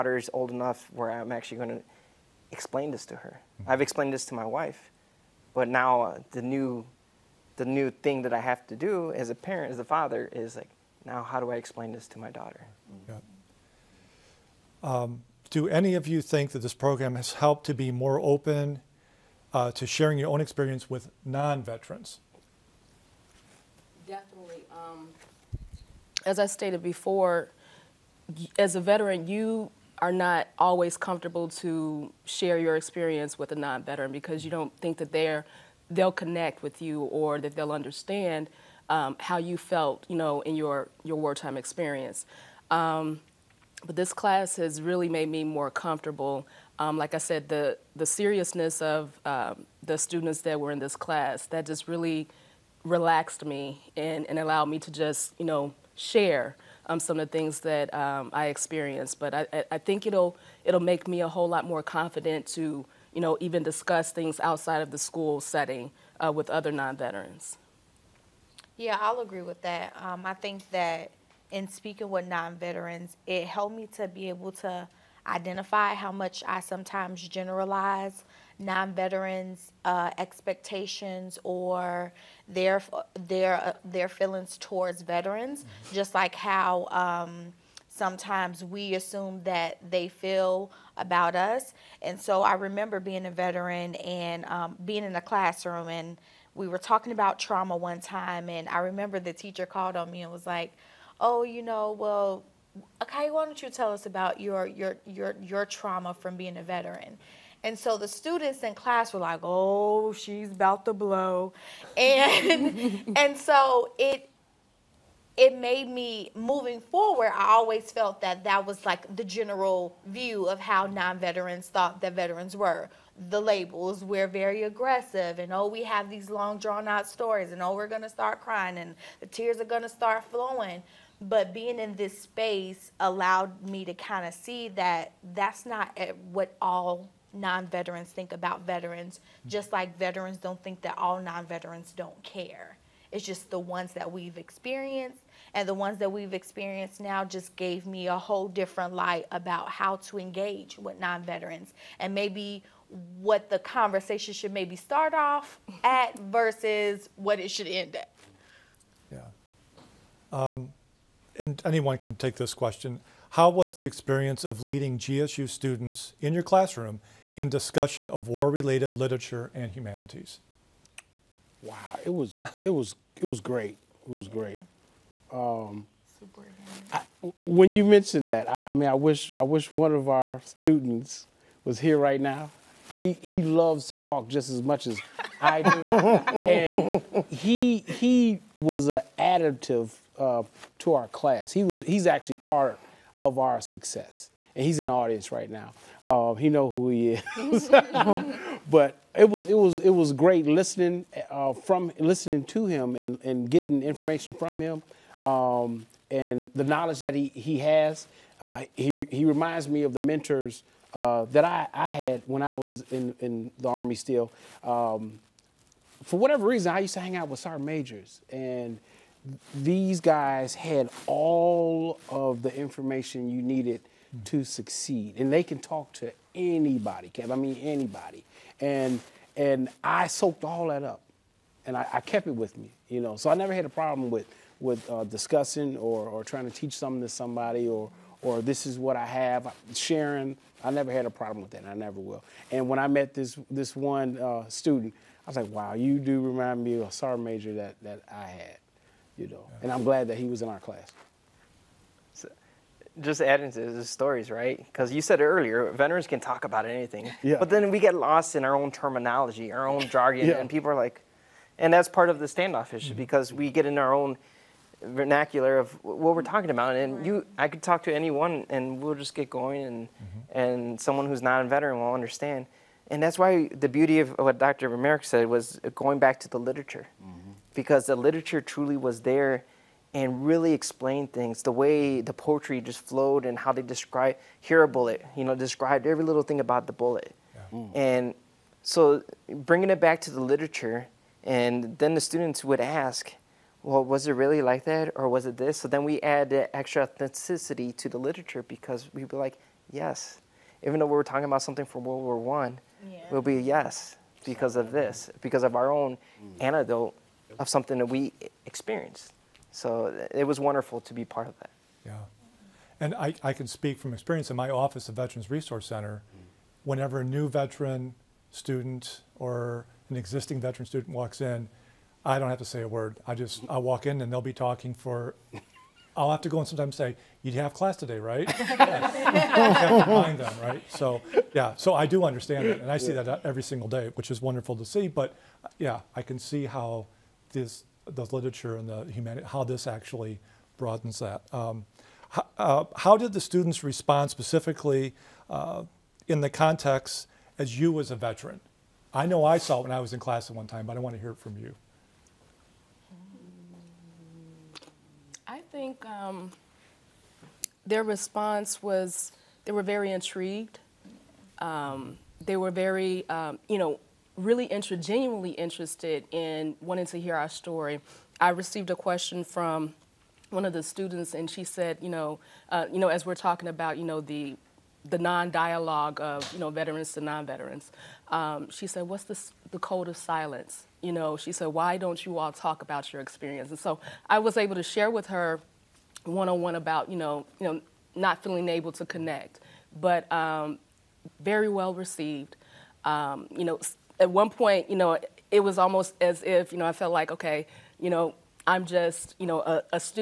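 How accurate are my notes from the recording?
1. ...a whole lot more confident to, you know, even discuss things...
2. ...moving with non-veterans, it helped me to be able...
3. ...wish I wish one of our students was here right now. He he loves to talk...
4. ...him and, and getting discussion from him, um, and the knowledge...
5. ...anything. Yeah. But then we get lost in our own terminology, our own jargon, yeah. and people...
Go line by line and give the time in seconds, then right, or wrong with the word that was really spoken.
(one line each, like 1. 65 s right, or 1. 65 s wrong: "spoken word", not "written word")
1. 61 s right
2. 71 s wrong: "speaking", not "moving"
3. 178 s right
4. 202 s wrong: "information", not "discussion"
5. 256 s right.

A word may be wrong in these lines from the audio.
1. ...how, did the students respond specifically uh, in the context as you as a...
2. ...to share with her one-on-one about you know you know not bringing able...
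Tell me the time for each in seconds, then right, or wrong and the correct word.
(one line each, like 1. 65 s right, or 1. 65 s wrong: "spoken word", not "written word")
1. 342 s right
2. 384 s wrong: "feeling", not "bringing".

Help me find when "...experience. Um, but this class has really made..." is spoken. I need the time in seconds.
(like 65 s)
41 s.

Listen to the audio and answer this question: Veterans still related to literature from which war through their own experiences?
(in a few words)
World War One.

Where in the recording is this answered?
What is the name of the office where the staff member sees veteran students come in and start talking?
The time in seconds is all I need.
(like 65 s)
314 s.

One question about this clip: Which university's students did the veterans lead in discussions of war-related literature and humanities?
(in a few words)
GSU.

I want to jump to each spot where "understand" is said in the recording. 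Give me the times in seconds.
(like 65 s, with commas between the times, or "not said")
37 s, 271 s, 332 s.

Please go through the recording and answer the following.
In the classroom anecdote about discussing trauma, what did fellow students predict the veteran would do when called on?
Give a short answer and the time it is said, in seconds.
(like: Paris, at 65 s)
Blow, at 110 s.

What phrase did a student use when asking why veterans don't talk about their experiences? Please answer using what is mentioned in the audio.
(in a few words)
Code of silence.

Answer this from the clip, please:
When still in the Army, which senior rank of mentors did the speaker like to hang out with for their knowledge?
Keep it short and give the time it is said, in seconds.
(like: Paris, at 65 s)
Sergeant majors, at 217 s.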